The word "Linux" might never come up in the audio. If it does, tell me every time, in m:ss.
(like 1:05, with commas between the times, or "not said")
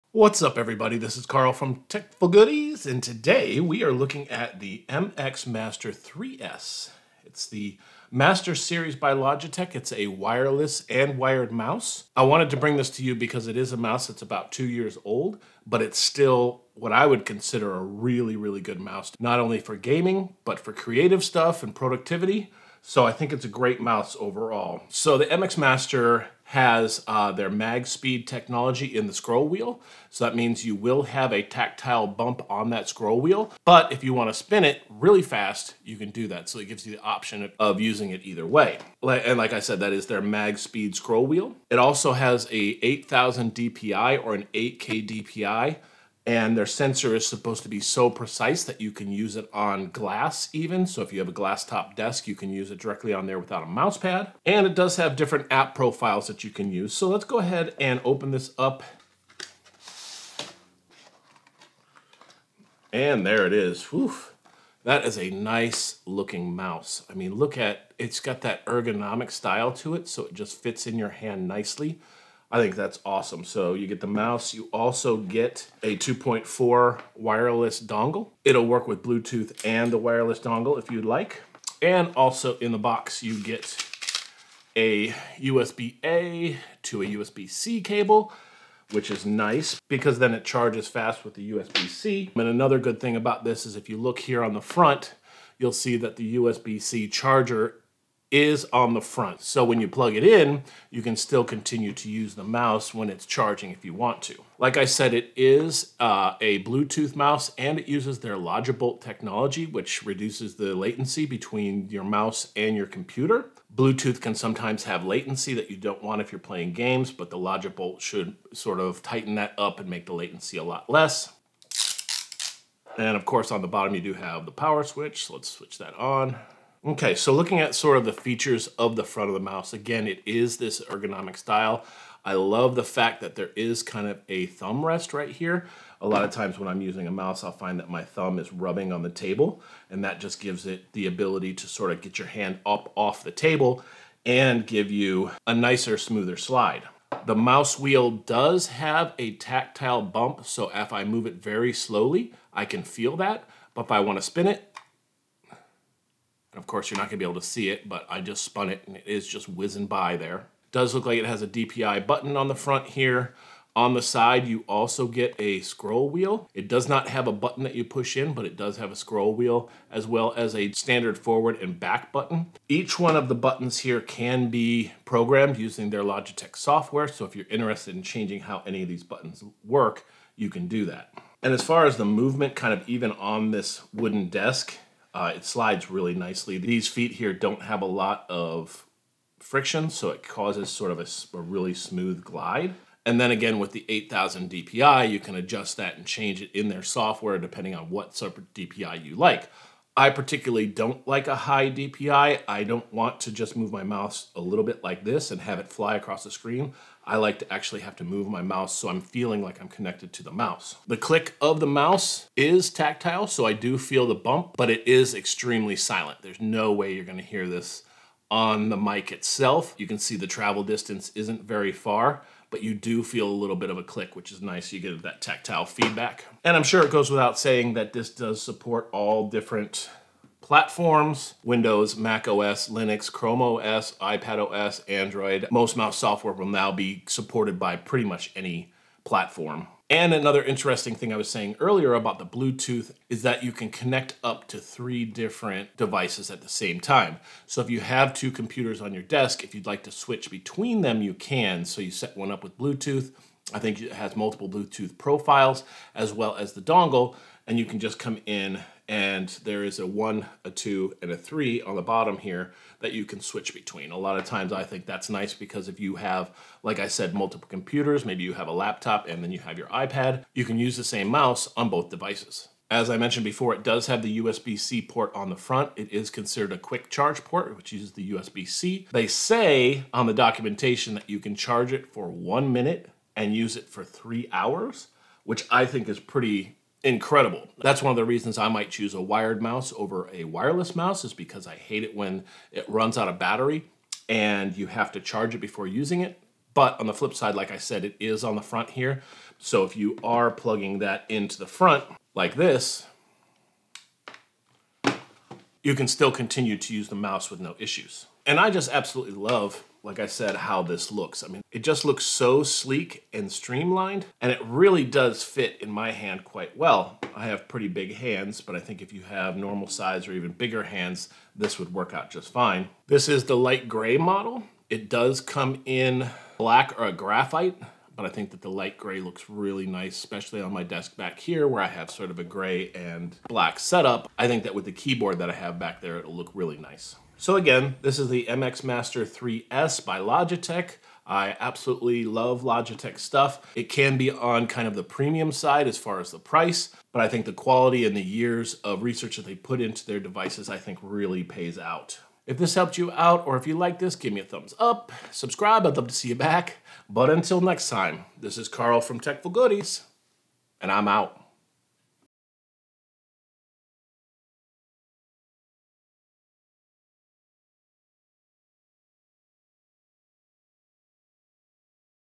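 3:52.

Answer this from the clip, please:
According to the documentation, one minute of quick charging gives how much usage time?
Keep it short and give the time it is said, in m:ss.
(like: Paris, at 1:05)
3 hours, at 4:43.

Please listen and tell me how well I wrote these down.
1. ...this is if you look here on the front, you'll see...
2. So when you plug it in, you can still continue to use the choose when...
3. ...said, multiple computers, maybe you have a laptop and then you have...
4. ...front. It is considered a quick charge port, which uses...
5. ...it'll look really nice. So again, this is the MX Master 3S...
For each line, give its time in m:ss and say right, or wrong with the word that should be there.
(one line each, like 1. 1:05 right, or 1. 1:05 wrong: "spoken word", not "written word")
1. 1:33 right
2. 1:39 wrong: "mouse", not "choose"
3. 4:26 right
4. 4:35 right
5. 5:35 right.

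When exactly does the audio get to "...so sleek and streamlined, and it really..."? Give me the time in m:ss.
5:12.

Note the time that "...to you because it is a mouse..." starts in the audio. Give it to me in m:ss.
0:12.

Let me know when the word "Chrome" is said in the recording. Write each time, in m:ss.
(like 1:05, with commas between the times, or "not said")
3:53.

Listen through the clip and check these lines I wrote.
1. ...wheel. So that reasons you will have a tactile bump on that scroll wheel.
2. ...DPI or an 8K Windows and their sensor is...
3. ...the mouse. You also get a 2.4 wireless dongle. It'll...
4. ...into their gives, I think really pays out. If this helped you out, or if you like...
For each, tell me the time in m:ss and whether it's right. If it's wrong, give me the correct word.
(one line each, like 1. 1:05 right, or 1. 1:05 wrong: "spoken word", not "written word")
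1. 0:29 wrong: "means", not "reasons"
2. 0:43 wrong: "DPI", not "Windows"
3. 1:14 right
4. 5:49 wrong: "devices", not "gives".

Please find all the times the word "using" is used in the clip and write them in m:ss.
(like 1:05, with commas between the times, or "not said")
0:37, 2:16, 2:55, 4:55.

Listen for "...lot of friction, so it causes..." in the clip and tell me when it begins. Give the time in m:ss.
3:07.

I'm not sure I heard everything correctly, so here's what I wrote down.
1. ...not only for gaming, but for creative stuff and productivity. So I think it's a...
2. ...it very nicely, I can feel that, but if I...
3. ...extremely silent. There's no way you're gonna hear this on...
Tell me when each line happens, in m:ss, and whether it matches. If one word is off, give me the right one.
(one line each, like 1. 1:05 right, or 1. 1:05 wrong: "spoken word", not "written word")
1. 0:19 right
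2. 2:31 wrong: "slowly", not "nicely"
3. 3:35 right.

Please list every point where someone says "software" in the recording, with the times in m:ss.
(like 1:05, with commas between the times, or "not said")
2:56, 3:16, 3:55.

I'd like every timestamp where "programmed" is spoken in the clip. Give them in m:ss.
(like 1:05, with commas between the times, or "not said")
2:55.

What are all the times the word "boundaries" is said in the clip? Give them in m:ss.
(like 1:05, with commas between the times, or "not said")
not said.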